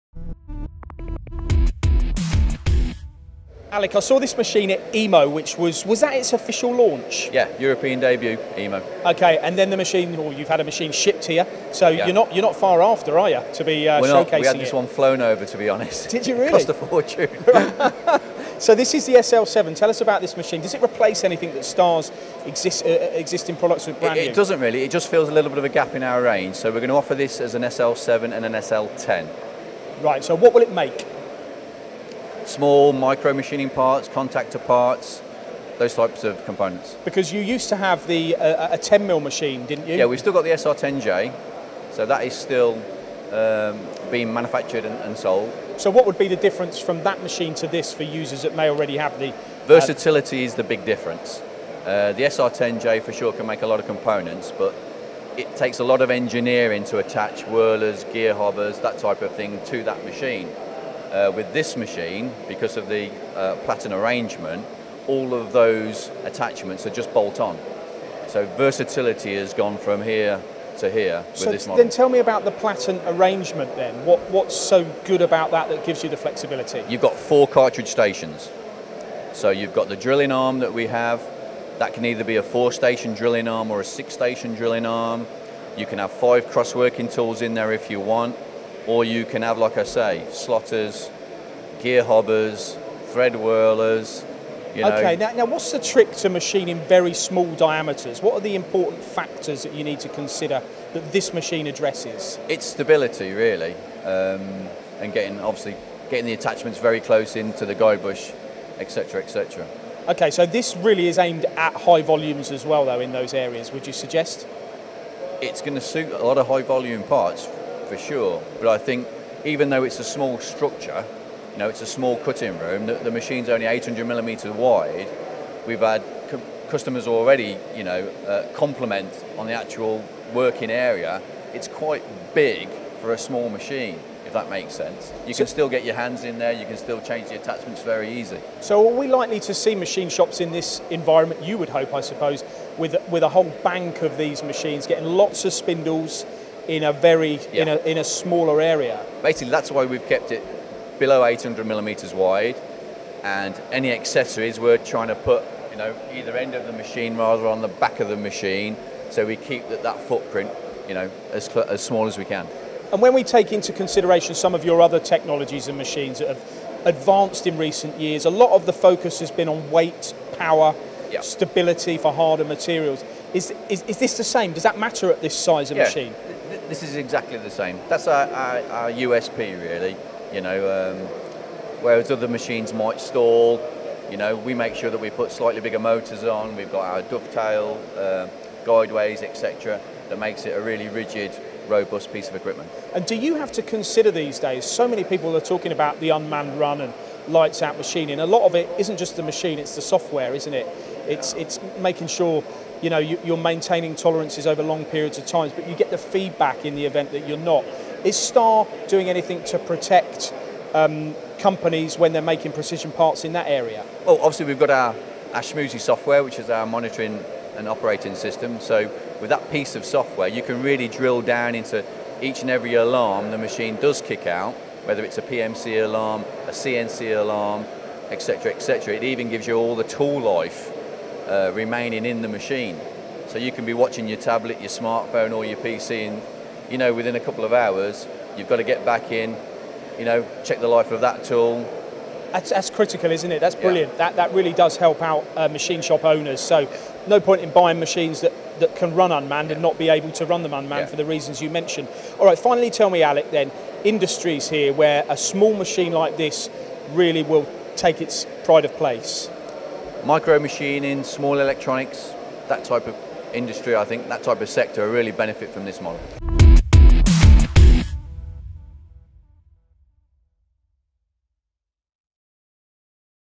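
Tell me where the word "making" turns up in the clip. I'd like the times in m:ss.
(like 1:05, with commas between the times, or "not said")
3:21, 3:32.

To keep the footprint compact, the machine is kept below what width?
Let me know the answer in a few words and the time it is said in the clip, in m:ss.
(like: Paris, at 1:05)
800 millimetres, at 2:31.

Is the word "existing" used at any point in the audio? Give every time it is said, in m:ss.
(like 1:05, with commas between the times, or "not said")
0:23.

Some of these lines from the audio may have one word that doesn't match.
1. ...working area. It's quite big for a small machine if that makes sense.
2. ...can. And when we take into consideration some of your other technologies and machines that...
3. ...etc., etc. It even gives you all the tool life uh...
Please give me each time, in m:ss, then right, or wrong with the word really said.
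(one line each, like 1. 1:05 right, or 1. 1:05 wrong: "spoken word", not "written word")
1. 2:10 right
2. 2:42 right
3. 3:48 right.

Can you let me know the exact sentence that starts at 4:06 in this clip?
So no point in buying machines that, that can run unmanned yeah.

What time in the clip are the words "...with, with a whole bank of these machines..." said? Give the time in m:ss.
2:22.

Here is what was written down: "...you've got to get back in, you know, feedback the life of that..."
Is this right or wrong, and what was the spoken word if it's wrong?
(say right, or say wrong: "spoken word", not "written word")
wrong: "check", not "feedback".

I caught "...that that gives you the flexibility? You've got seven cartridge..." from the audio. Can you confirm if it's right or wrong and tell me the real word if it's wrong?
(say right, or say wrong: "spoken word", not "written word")
wrong: "four", not "seven".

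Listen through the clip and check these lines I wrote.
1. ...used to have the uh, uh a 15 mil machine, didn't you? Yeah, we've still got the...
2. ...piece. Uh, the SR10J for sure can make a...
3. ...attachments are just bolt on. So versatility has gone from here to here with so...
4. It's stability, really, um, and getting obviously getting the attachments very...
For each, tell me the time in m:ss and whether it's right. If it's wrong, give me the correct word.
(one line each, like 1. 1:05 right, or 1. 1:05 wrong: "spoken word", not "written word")
1. 0:37 wrong: "10", not "15"
2. 0:50 wrong: "difference", not "piece"
3. 1:06 right
4. 1:42 right.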